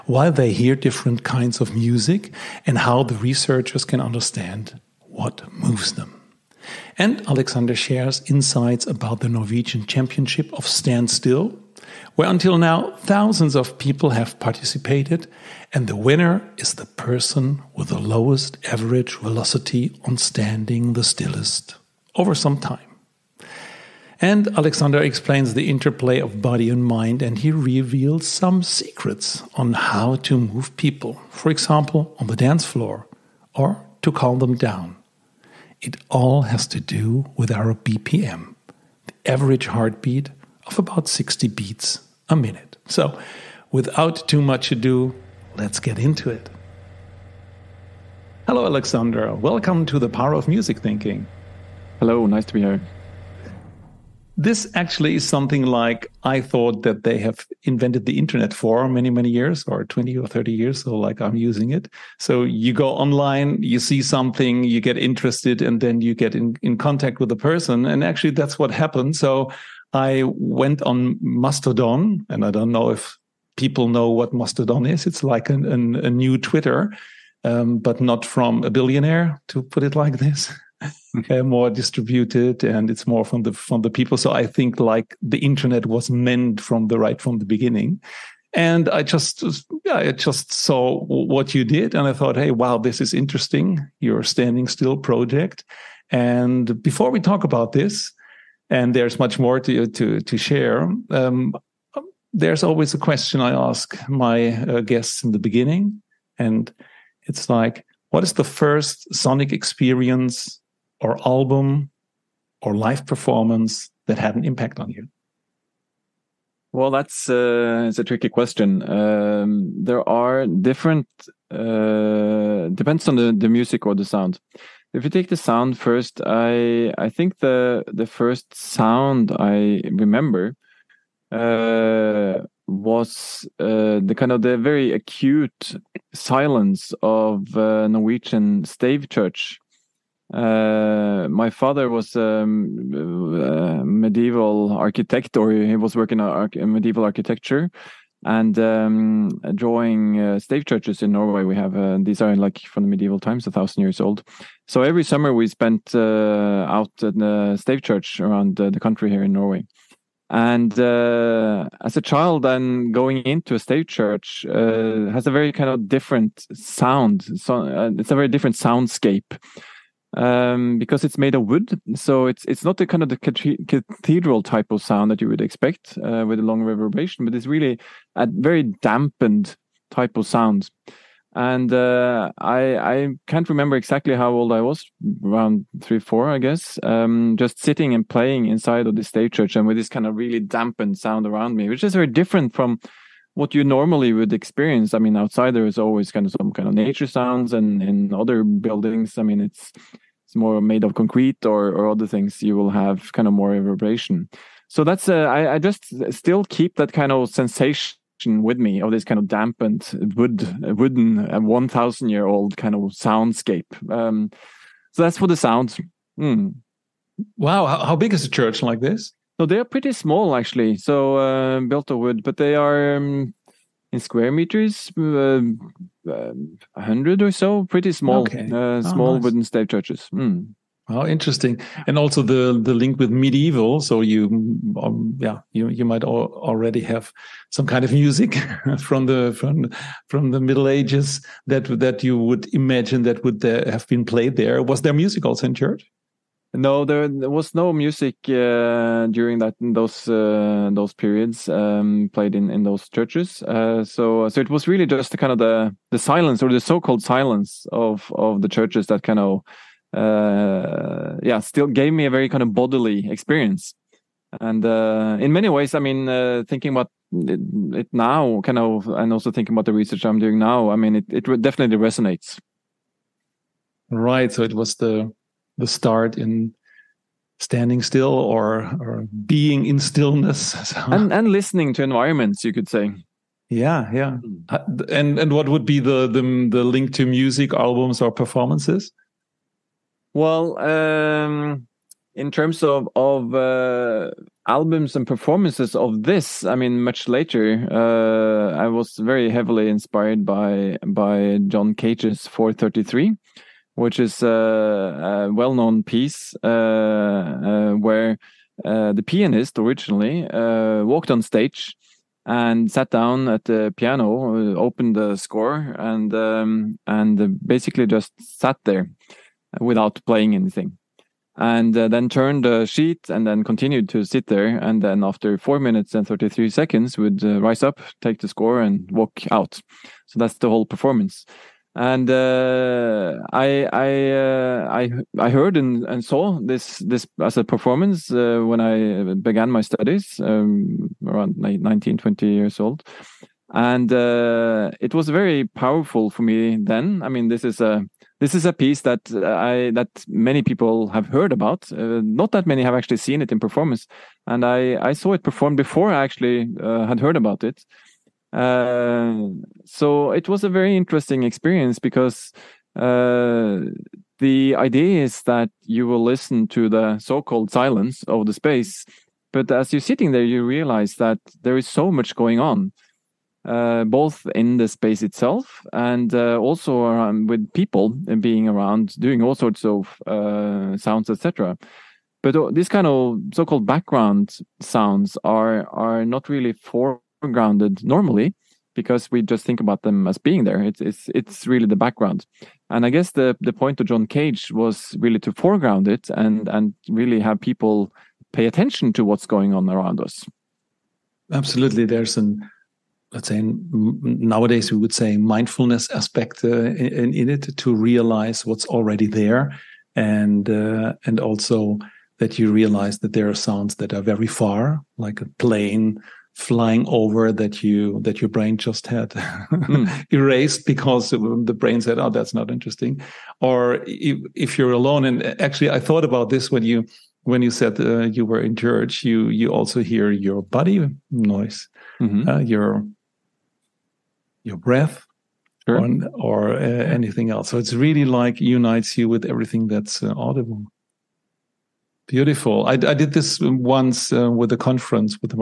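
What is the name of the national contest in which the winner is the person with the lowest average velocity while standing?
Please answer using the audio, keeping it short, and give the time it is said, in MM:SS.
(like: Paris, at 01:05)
Norwegian Championship of Standstill, at 00:09.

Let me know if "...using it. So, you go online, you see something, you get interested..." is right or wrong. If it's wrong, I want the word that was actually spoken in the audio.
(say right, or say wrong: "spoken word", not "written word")
right.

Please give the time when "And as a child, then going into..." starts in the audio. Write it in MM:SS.
02:40.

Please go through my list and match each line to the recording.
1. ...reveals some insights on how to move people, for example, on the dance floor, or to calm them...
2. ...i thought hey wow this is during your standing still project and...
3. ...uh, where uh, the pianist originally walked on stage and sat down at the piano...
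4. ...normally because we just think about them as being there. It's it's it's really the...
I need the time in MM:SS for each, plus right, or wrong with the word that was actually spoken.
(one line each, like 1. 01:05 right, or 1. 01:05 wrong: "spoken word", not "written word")
1. 00:27 wrong: "secrets", not "insights"
2. 01:32 wrong: "interesting", not "during"
3. 05:06 right
4. 06:27 right.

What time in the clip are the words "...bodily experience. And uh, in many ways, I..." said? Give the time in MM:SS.
04:22.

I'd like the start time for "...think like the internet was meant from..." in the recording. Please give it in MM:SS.
01:24.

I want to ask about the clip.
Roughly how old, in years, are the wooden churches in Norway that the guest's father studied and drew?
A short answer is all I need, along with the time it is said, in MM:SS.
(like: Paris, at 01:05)
1,000 years, at 02:33.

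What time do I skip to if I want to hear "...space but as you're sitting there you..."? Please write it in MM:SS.
06:08.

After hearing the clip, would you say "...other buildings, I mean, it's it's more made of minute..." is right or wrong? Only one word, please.
wrong.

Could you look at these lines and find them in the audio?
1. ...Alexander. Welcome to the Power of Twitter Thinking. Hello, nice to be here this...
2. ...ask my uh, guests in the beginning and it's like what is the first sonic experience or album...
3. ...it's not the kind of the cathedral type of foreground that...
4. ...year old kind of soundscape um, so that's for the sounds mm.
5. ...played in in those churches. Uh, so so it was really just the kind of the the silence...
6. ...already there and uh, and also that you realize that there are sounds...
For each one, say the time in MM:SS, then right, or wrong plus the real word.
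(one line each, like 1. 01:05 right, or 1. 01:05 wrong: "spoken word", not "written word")
1. 00:48 wrong: "Music", not "Twitter"
2. 01:43 right
3. 02:52 wrong: "sound", not "foreground"
4. 03:32 right
5. 04:12 right
6. 06:48 right.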